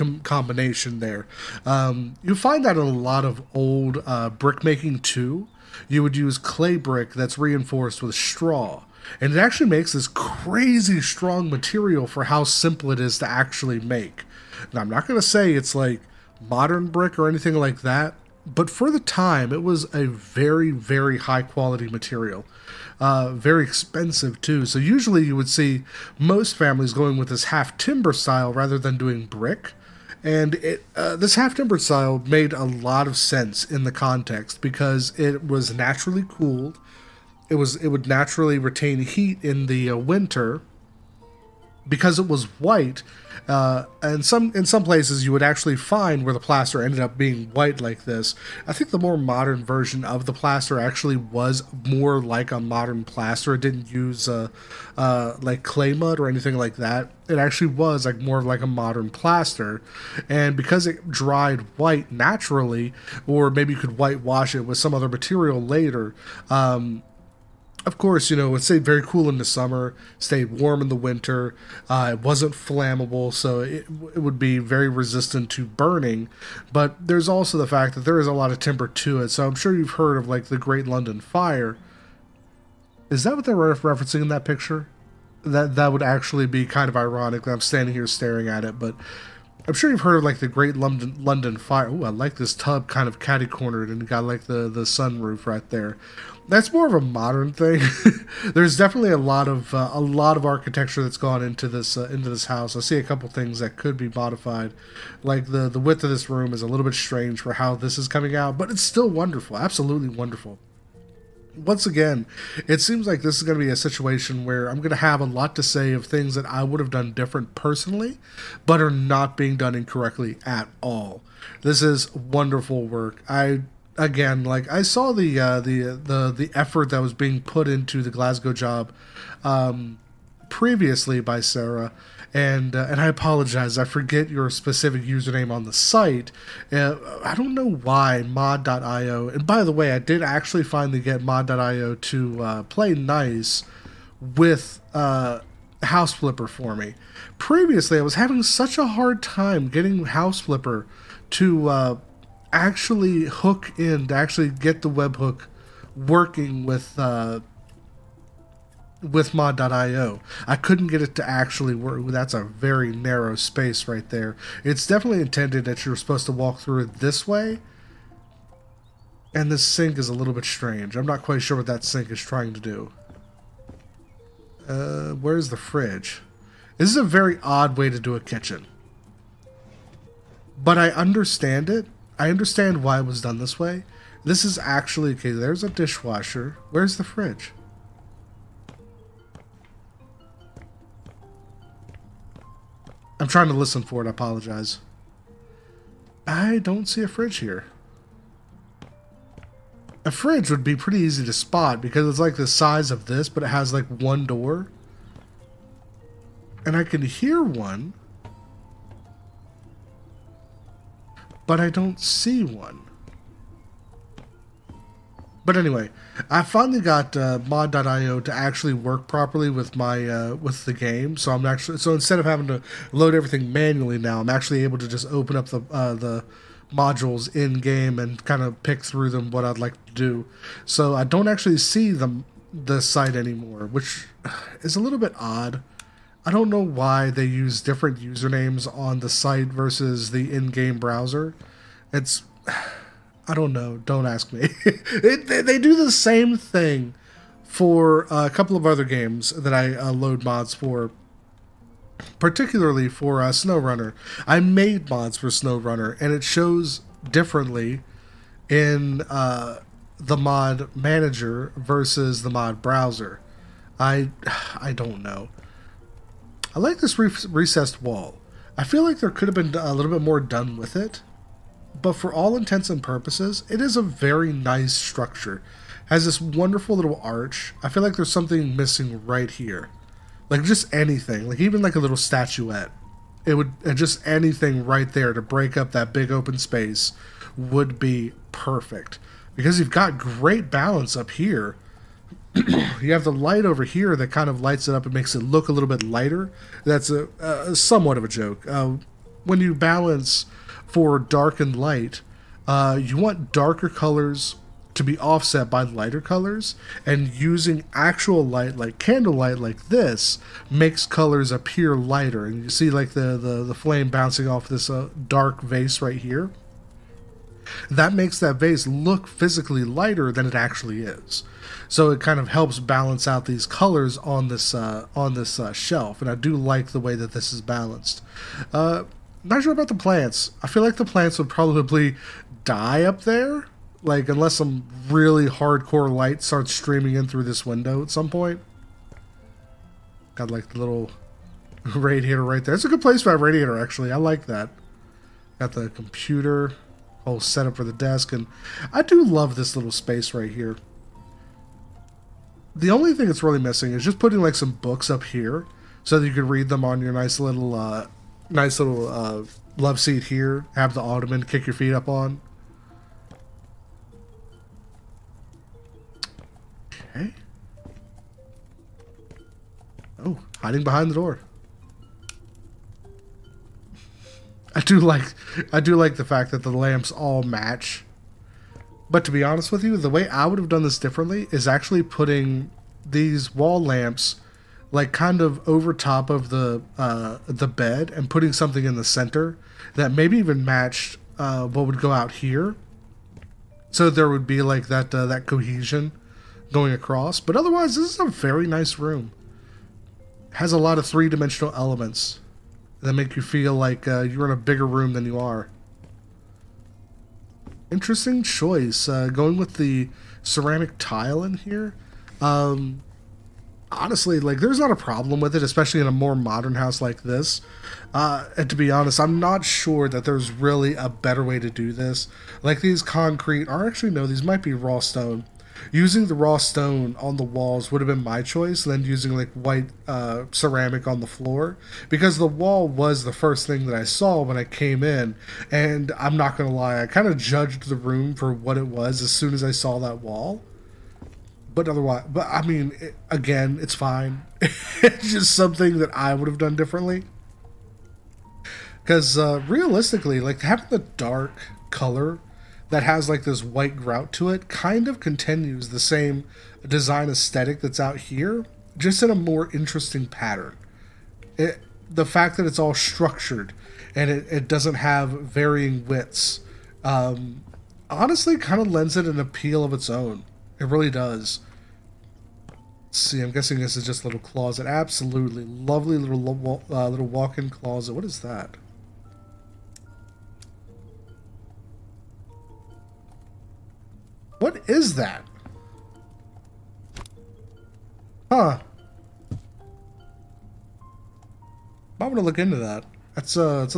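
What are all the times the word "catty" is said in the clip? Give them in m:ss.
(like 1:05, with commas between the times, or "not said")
1:33.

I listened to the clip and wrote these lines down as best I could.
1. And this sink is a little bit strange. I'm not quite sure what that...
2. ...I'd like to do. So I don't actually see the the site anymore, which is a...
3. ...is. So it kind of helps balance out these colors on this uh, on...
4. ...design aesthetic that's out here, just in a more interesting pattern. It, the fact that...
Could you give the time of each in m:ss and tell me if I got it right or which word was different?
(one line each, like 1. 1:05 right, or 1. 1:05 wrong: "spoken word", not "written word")
1. 2:49 right
2. 3:49 right
3. 5:20 right
4. 7:36 right.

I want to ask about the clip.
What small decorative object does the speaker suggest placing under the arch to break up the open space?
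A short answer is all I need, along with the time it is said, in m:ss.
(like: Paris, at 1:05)
statuette, at 4:41.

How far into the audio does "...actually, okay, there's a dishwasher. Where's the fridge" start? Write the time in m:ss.
3:04.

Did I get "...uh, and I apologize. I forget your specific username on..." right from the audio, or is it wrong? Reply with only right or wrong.
right.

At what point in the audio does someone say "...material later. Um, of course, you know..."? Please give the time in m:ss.
1:05.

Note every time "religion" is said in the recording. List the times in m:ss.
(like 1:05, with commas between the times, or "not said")
not said.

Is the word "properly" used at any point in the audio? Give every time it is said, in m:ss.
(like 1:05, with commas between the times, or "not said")
3:39.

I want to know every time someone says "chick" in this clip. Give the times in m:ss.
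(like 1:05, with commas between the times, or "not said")
not said.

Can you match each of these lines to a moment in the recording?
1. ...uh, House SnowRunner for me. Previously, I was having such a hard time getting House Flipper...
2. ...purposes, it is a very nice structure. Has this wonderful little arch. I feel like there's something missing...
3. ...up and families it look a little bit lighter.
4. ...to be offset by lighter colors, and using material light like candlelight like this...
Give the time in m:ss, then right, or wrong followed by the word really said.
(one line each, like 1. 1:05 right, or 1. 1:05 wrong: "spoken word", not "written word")
1. 2:24 wrong: "Flipper", not "SnowRunner"
2. 4:32 right
3. 4:54 wrong: "makes", not "families"
4. 5:04 wrong: "actual", not "material".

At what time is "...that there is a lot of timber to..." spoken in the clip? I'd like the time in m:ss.
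1:17.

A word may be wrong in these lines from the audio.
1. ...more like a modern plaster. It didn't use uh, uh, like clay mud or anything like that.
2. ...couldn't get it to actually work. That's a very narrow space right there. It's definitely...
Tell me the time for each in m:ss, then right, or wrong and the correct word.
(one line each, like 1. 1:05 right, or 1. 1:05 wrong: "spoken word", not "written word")
1. 0:51 right
2. 2:40 right.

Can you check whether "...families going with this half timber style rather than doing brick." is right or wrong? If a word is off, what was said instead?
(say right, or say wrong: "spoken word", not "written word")
right.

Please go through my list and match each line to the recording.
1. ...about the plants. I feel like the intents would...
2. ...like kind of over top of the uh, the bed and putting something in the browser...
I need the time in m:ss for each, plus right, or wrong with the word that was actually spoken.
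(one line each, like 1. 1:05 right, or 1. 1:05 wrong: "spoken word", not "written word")
1. 5:29 wrong: "plants", not "intents"
2. 6:24 wrong: "center", not "browser".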